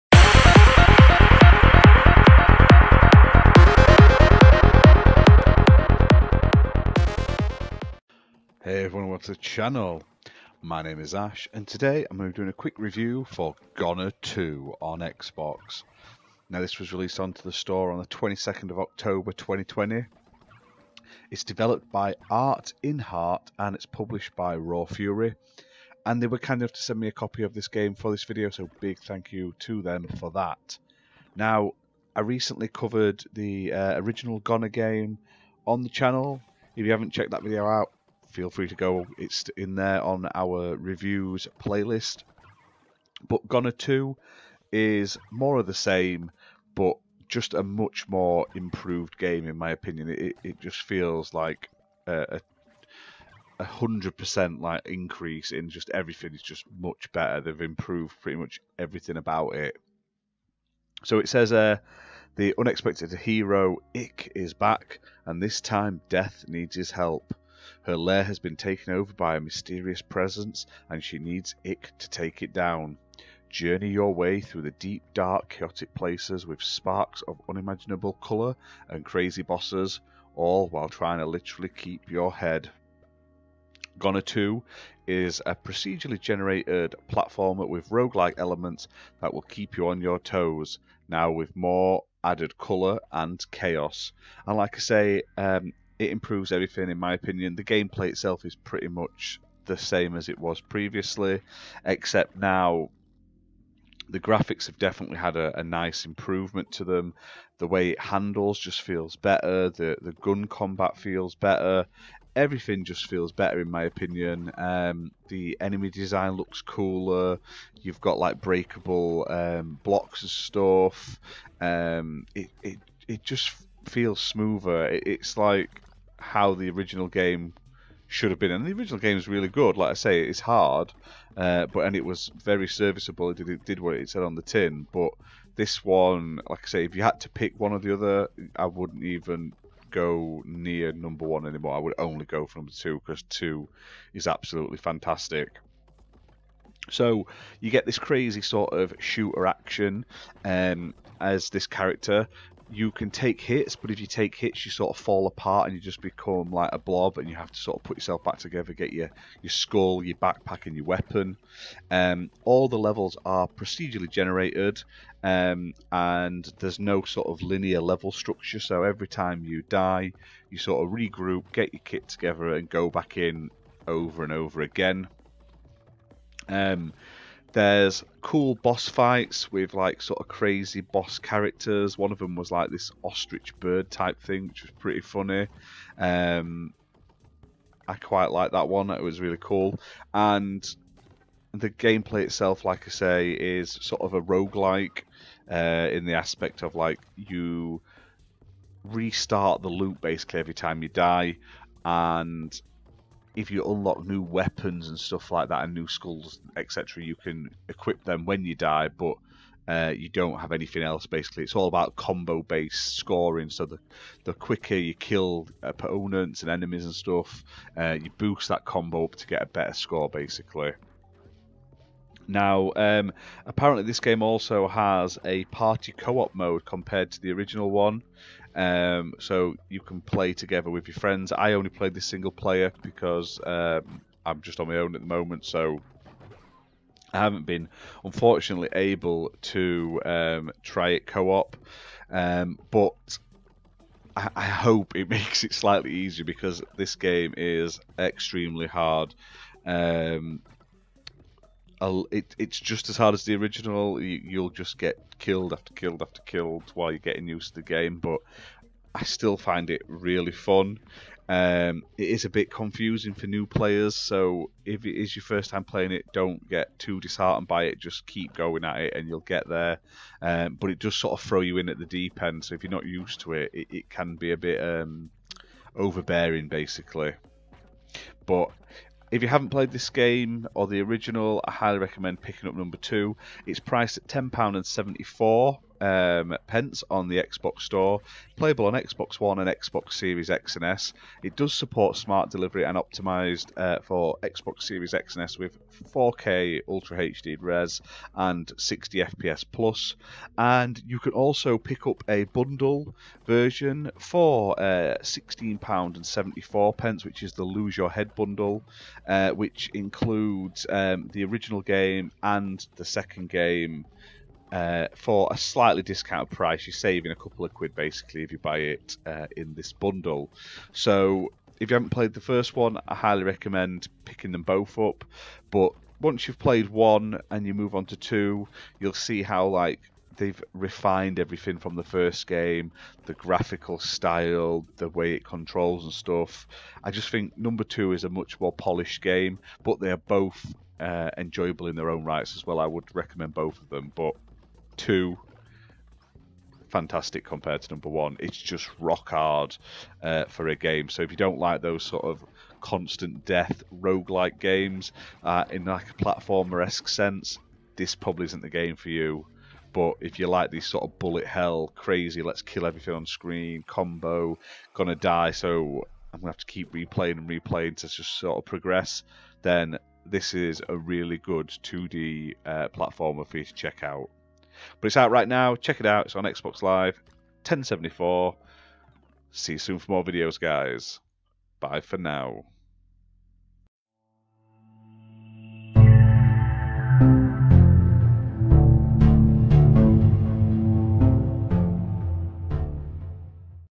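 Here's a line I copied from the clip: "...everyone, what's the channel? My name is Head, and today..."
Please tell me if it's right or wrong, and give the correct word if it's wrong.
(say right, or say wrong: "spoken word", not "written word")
wrong: "Ash", not "Head".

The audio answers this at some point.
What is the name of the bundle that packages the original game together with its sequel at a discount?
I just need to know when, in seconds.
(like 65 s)
307 s.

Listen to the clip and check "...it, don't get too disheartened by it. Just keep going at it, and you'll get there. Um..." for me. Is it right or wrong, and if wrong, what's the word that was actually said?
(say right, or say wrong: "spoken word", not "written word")
right.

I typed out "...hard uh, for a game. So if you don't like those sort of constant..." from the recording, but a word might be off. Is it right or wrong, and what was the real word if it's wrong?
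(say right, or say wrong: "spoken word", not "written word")
right.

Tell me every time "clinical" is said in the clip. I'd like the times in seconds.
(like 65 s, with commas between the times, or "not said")
not said.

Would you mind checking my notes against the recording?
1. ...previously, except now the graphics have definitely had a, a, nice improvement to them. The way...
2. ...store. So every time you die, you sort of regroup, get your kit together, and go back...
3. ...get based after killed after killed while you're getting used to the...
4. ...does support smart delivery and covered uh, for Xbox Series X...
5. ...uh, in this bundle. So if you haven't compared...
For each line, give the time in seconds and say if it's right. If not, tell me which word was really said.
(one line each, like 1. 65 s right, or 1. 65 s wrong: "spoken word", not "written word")
1. 100 s right
2. 168 s wrong: "structure", not "store"
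3. 254 s wrong: "killed", not "based"
4. 291 s wrong: "optimized", not "covered"
5. 319 s wrong: "played", not "compared".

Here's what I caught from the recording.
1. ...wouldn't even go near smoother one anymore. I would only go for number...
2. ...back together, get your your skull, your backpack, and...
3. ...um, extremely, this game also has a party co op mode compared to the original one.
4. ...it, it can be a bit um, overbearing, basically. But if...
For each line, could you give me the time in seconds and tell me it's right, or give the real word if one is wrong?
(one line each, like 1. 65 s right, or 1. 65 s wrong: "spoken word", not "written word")
1. 138 s wrong: "number", not "smoother"
2. 158 s right
3. 222 s wrong: "apparently", not "extremely"
4. 273 s right.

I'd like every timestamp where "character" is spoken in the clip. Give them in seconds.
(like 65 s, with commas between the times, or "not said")
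151 s, 181 s.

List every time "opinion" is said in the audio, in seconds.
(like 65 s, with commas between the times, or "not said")
49 s, 97 s, 113 s.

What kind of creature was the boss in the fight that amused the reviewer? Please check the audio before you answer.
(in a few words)
ostrich bird.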